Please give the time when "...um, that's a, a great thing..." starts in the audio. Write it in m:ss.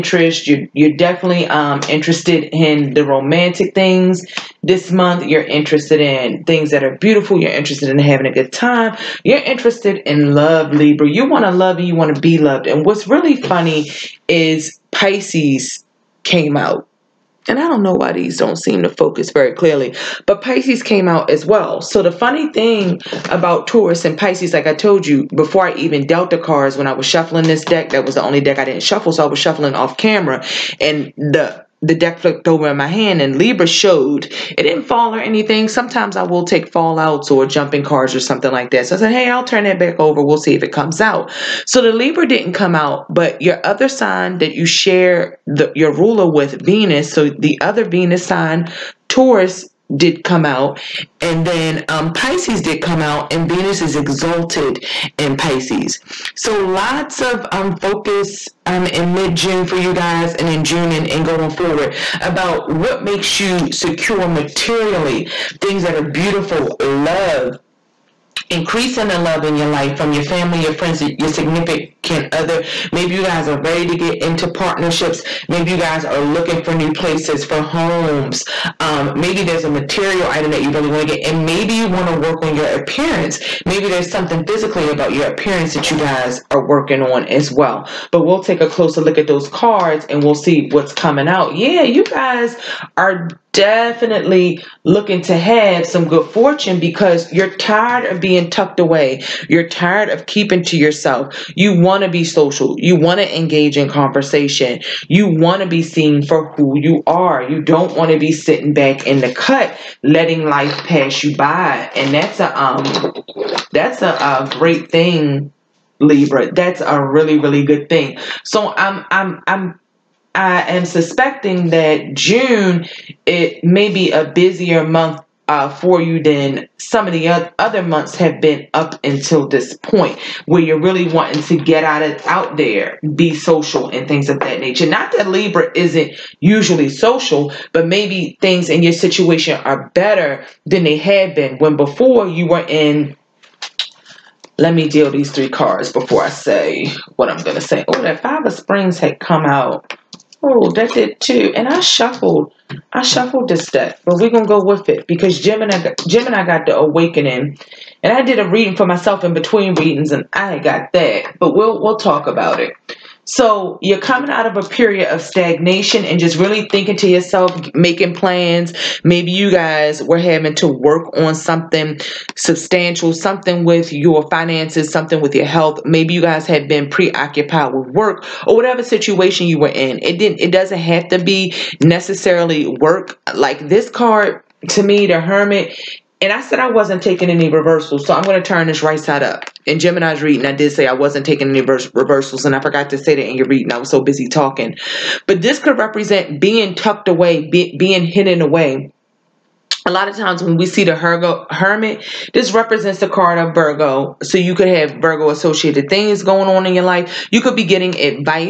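1:52.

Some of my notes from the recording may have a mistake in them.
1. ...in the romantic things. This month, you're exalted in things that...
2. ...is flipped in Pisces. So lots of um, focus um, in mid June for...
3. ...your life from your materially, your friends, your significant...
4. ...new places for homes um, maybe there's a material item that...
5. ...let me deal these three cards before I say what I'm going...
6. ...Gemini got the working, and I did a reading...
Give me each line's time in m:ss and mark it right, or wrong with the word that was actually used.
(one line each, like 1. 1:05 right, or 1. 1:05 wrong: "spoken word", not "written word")
1. 0:02 wrong: "interested", not "exalted"
2. 0:53 wrong: "exalted", not "flipped"
3. 1:09 wrong: "family", not "materially"
4. 1:16 right
5. 2:24 right
6. 2:36 wrong: "awakening", not "working".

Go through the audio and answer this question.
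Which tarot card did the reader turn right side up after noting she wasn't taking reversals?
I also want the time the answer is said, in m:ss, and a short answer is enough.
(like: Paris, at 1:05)
The Hermit, at 3:05.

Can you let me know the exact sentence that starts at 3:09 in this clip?
In Gemini's reading, I did say I wasn't taking any reversals, and I forgot to say that in your reading.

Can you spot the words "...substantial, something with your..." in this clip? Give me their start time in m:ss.
2:52.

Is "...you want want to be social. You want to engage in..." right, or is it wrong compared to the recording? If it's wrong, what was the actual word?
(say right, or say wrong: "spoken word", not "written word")
right.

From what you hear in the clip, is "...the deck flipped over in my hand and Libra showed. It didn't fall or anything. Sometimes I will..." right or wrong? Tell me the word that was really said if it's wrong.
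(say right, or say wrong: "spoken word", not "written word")
right.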